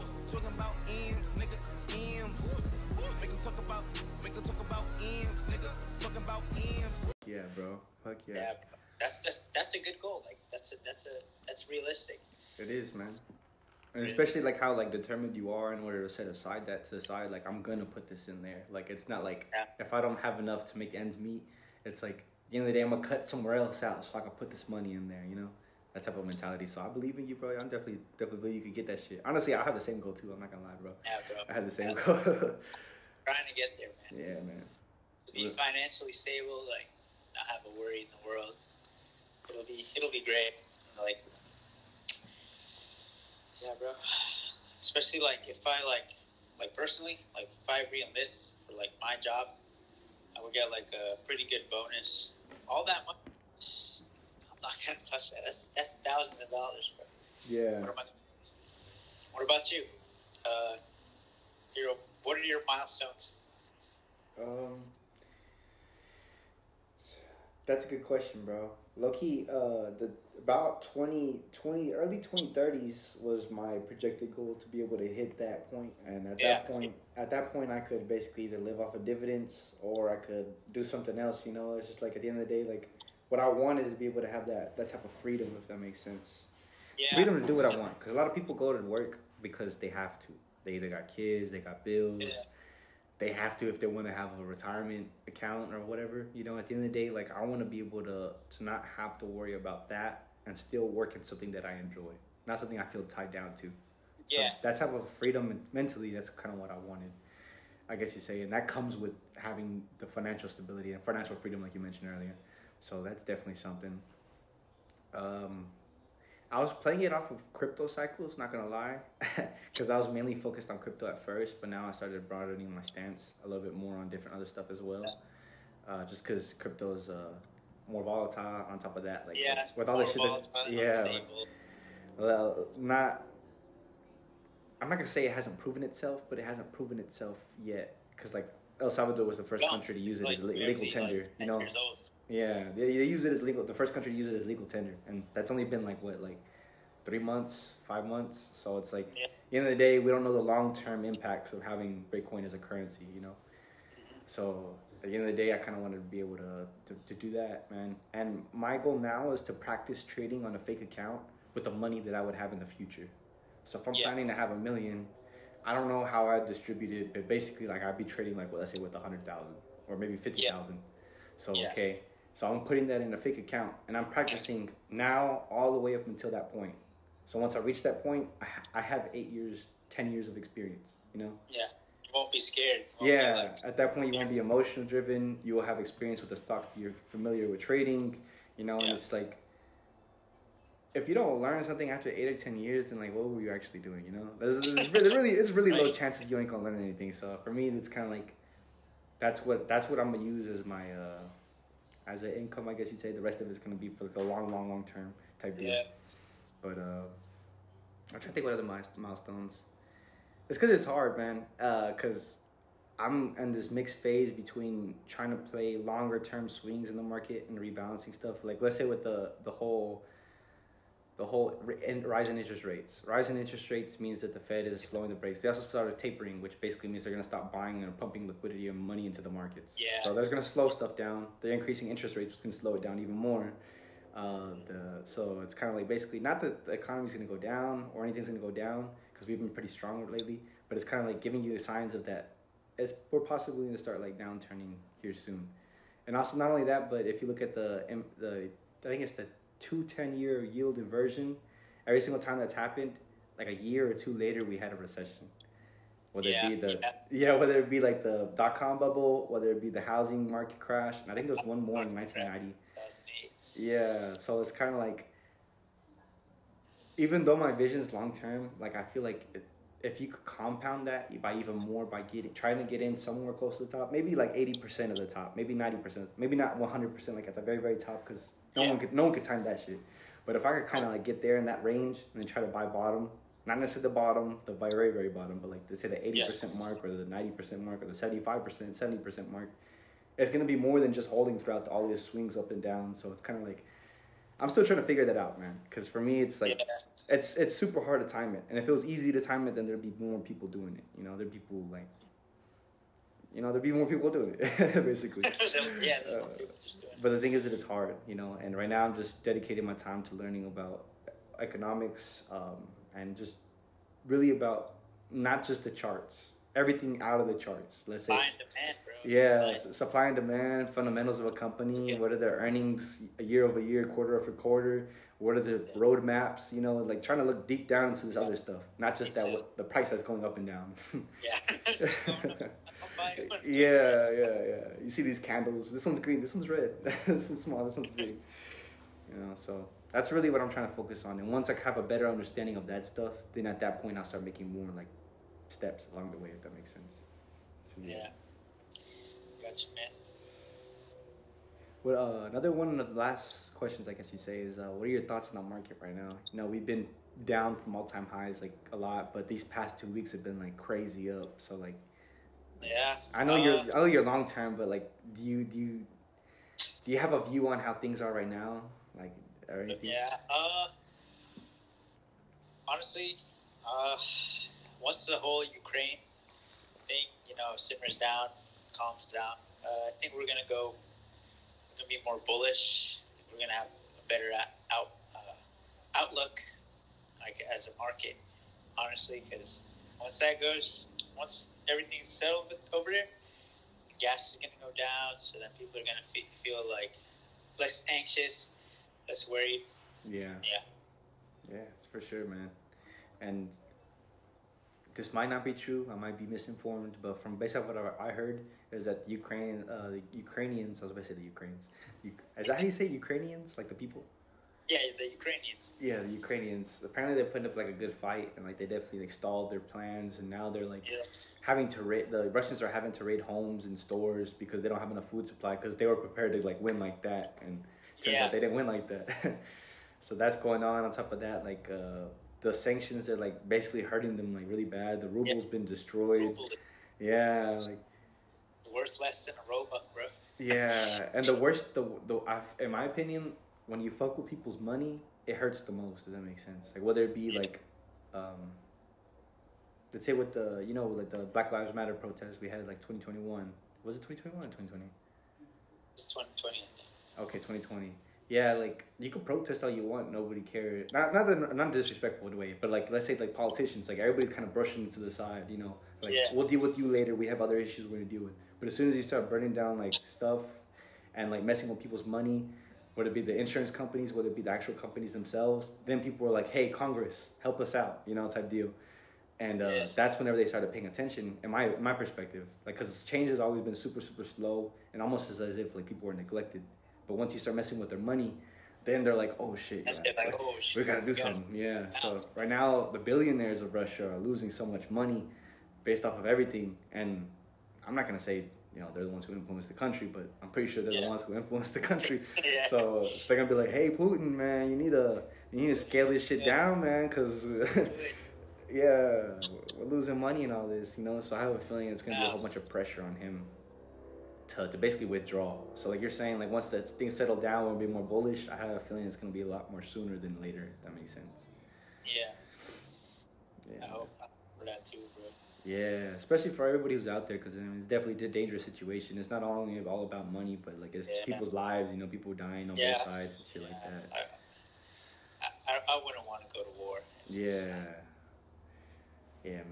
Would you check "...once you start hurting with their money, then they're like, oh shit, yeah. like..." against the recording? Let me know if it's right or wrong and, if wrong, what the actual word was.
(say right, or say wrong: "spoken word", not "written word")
wrong: "messing", not "hurting".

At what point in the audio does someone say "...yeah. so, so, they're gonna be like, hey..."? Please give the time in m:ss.
8:22.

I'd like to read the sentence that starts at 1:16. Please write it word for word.
that point, at that point, I could basically either live off of dividends or I could do something else.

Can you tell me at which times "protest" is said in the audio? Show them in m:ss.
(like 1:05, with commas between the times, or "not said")
7:31, 7:39.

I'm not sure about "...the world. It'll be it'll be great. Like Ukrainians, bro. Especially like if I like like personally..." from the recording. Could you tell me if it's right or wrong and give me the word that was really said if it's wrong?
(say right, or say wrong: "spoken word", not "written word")
wrong: "Yeah", not "Ukrainians".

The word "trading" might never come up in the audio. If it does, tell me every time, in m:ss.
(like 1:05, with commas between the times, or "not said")
2:40, 2:48, 3:07.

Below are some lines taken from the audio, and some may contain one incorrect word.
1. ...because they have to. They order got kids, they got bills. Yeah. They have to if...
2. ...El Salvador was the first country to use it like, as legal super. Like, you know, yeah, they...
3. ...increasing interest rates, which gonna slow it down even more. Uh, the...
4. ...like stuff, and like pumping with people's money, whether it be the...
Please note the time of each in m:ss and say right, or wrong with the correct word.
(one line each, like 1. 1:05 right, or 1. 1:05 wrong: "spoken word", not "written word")
1. 1:29 wrong: "either", not "order"
2. 2:18 wrong: "tender", not "super"
3. 3:51 right
4. 7:49 wrong: "messing", not "pumping".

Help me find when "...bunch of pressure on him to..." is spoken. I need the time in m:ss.
8:32.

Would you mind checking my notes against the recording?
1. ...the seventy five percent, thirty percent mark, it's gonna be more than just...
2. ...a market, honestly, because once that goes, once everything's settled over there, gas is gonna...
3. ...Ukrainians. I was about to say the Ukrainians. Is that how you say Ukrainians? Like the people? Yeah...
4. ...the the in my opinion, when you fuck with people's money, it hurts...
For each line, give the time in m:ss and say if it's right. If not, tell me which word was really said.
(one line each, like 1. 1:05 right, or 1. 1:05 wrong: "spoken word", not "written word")
1. 4:47 wrong: "seventy", not "thirty"
2. 6:27 right
3. 6:50 right
4. 7:21 right.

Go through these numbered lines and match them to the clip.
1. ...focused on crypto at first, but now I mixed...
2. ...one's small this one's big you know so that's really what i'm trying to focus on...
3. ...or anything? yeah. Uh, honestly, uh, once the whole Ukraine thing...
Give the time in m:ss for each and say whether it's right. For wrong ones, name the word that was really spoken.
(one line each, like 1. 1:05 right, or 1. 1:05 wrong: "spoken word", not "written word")
1. 2:00 wrong: "started", not "mixed"
2. 5:37 right
3. 6:09 right.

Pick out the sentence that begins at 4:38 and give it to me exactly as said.
one could no one could time that shit.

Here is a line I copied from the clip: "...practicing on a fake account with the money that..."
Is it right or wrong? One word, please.
wrong.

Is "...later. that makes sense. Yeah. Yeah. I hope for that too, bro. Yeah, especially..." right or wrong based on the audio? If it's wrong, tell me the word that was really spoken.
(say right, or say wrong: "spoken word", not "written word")
right.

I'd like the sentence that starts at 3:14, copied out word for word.
There's, there's really, it's really low chances you ain't gonna learn anything.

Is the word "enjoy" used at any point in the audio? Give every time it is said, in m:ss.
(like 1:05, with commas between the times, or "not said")
1:41.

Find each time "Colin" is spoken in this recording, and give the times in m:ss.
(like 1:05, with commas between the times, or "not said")
not said.